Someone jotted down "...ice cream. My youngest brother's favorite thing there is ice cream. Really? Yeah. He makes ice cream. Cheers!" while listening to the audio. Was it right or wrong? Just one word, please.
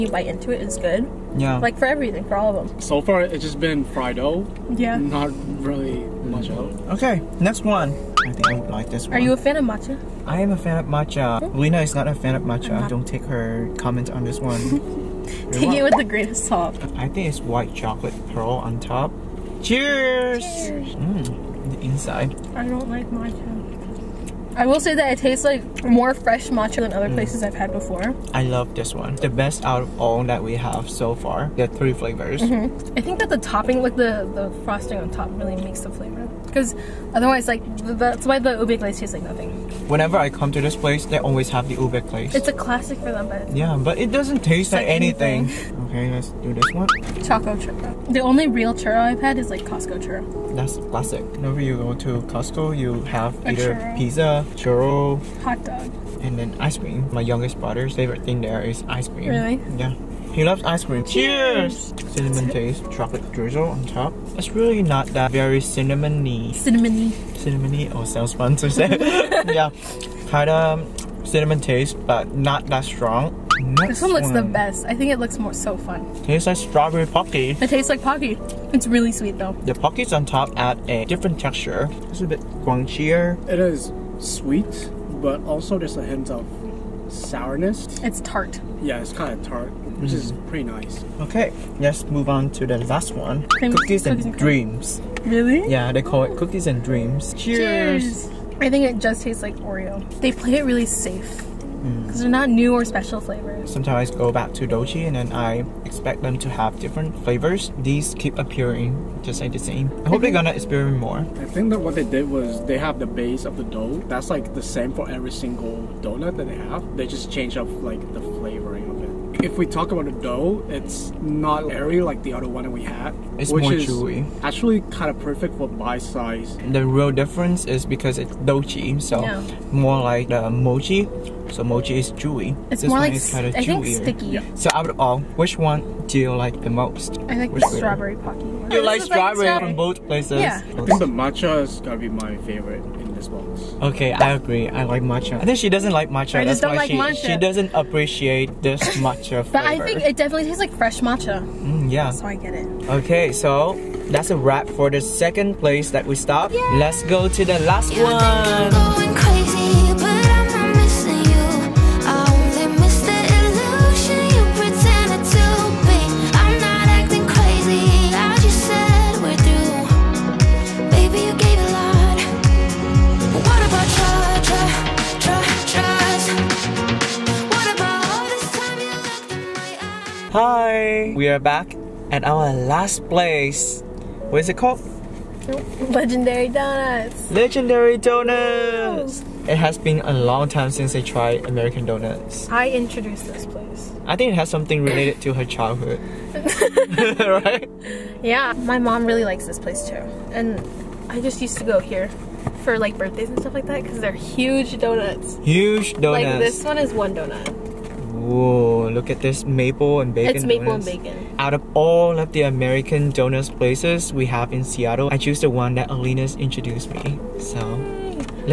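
wrong.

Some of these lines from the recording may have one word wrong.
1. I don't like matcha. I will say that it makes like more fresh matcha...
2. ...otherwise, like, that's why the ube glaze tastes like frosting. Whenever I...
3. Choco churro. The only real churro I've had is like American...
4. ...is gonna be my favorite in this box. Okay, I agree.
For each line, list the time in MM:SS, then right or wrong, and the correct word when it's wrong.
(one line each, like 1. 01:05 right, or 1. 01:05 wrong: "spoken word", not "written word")
1. 00:22 wrong: "tastes", not "makes"
2. 00:37 wrong: "nothing", not "frosting"
3. 00:47 wrong: "Costco", not "American"
4. 02:21 right.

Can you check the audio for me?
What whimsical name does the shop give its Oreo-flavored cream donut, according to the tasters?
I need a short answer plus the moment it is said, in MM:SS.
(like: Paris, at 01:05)
Cookies and dreams, at 01:36.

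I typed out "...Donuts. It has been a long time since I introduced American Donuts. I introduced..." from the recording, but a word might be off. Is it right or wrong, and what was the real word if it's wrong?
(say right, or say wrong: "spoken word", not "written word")
wrong: "tried", not "introduced".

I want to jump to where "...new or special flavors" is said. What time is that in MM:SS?
01:42.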